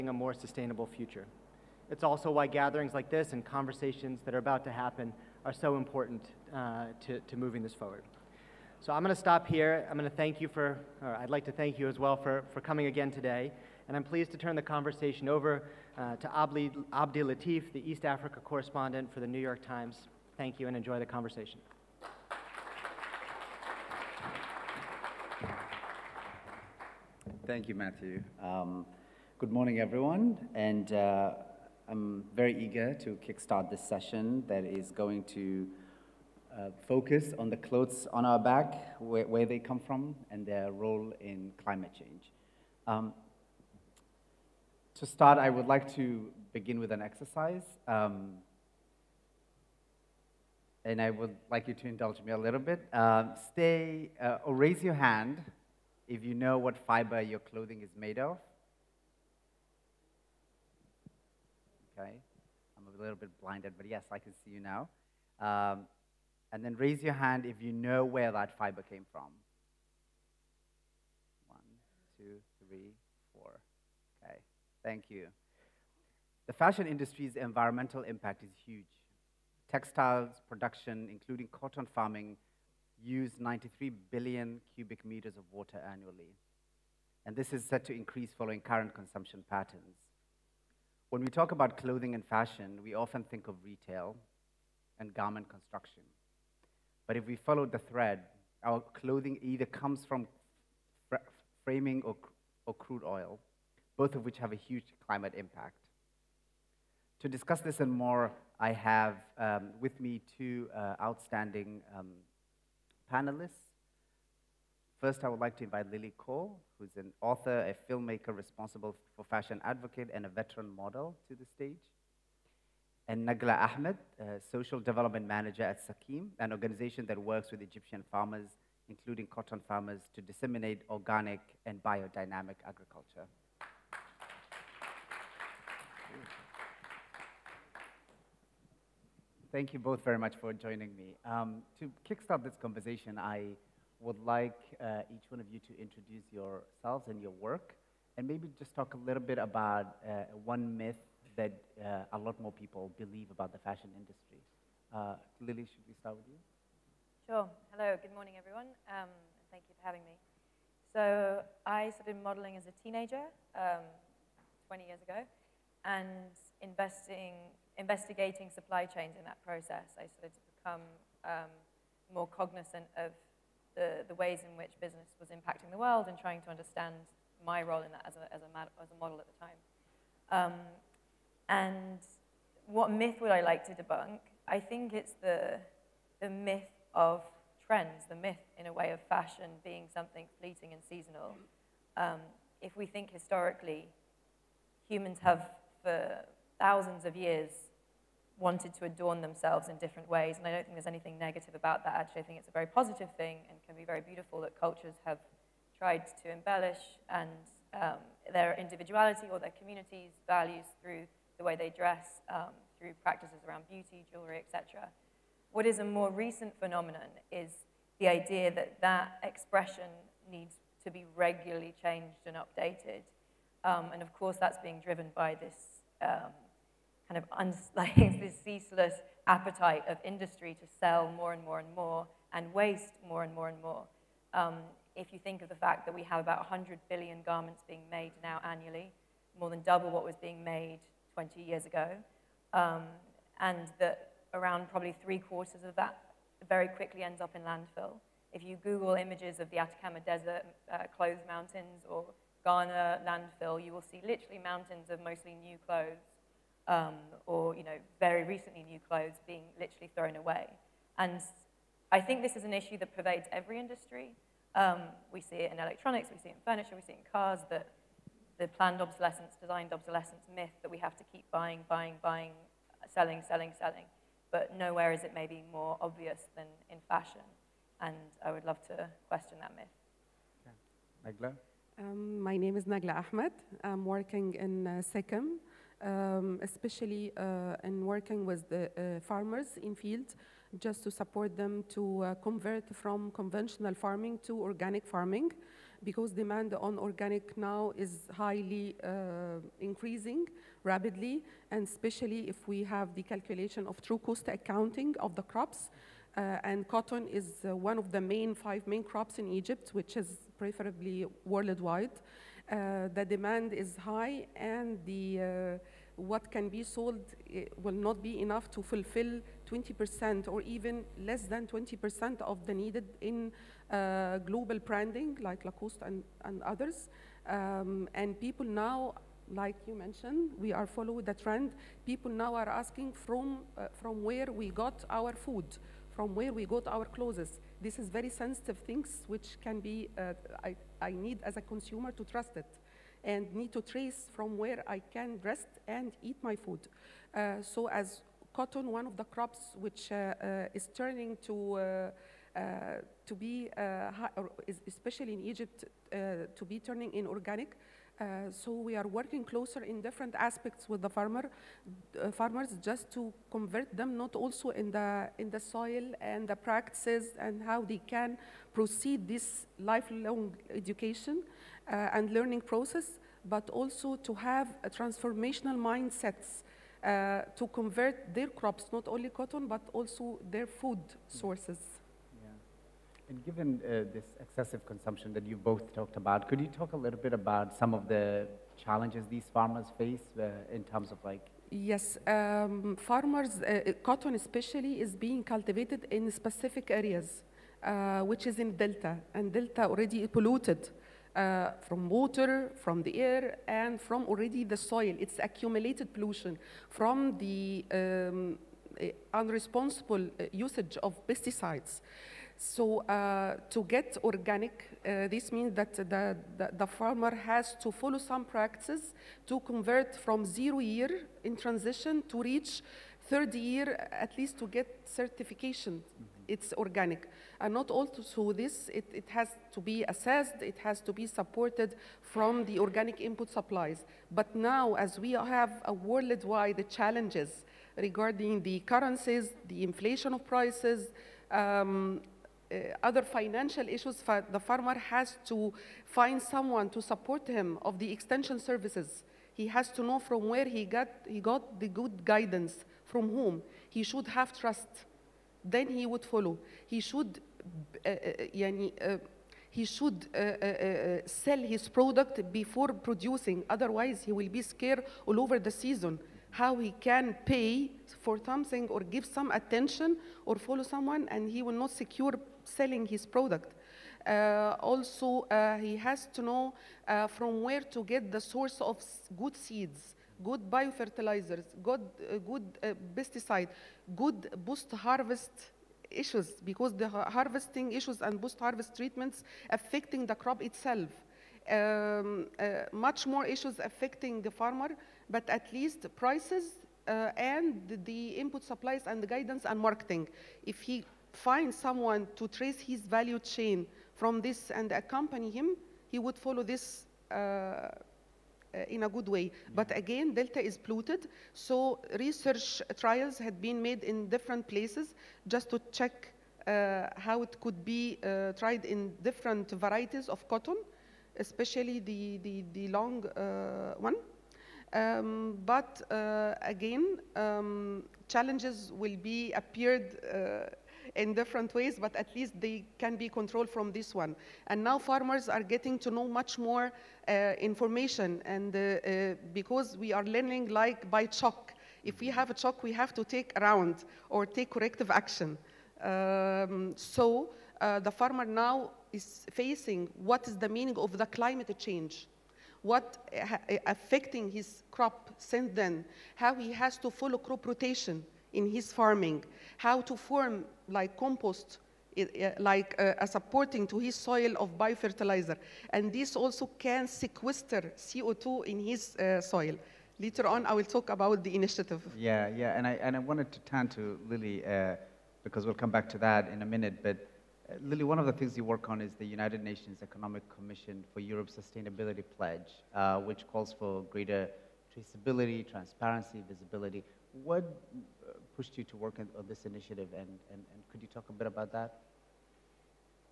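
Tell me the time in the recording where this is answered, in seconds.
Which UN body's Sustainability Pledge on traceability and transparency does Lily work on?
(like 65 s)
579 s.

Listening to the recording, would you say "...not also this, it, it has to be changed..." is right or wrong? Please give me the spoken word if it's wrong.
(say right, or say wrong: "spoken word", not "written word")
wrong: "assessed", not "changed".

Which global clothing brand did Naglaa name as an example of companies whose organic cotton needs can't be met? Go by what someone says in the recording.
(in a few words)
Lacoste.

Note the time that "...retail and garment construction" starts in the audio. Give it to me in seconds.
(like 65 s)
93 s.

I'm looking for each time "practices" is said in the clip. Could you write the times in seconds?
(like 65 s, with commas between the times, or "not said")
213 s, 366 s, 418 s.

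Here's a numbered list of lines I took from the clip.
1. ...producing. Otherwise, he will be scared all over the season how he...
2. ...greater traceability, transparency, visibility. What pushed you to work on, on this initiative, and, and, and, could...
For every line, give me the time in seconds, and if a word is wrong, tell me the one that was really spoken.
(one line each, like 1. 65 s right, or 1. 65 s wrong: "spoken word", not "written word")
1. 462 s right
2. 583 s right.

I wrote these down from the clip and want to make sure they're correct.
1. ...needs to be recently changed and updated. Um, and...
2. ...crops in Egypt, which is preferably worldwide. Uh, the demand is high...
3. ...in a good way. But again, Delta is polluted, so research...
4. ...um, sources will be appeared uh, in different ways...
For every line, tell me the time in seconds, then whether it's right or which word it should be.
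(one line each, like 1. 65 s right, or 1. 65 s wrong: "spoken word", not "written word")
1. 220 s wrong: "regularly", not "recently"
2. 308 s right
3. 508 s right
4. 527 s wrong: "challenges", not "sources".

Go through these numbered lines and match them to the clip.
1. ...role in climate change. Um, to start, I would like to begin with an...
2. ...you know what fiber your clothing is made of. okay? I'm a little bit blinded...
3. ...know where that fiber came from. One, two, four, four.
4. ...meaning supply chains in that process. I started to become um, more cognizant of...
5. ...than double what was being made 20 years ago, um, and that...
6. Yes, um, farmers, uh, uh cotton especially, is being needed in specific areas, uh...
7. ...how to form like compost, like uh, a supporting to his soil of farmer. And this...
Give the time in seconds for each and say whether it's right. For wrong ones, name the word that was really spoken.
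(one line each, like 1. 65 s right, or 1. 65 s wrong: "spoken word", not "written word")
1. 40 s right
2. 56 s right
3. 67 s wrong: "three", not "four"
4. 167 s wrong: "investigating", not "meaning"
5. 239 s right
6. 391 s wrong: "cultivated", not "needed"
7. 559 s wrong: "biofertilizer", not "farmer".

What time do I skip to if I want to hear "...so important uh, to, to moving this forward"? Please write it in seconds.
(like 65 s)
5 s.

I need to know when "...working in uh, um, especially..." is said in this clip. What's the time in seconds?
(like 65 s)
283 s.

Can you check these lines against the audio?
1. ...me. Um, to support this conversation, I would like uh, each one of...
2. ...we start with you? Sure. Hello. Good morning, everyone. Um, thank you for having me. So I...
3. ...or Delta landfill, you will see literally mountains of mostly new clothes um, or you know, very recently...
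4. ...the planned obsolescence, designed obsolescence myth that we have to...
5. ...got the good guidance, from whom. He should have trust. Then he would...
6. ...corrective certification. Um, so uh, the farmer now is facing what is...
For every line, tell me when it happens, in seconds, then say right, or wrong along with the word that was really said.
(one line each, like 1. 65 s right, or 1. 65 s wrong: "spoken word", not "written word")
1. 140 s wrong: "kickstart", not "support"
2. 155 s right
3. 251 s wrong: "Ghana", not "Delta"
4. 268 s right
5. 451 s right
6. 544 s wrong: "action", not "certification".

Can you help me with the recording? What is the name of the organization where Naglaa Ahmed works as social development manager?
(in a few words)
SEKEM.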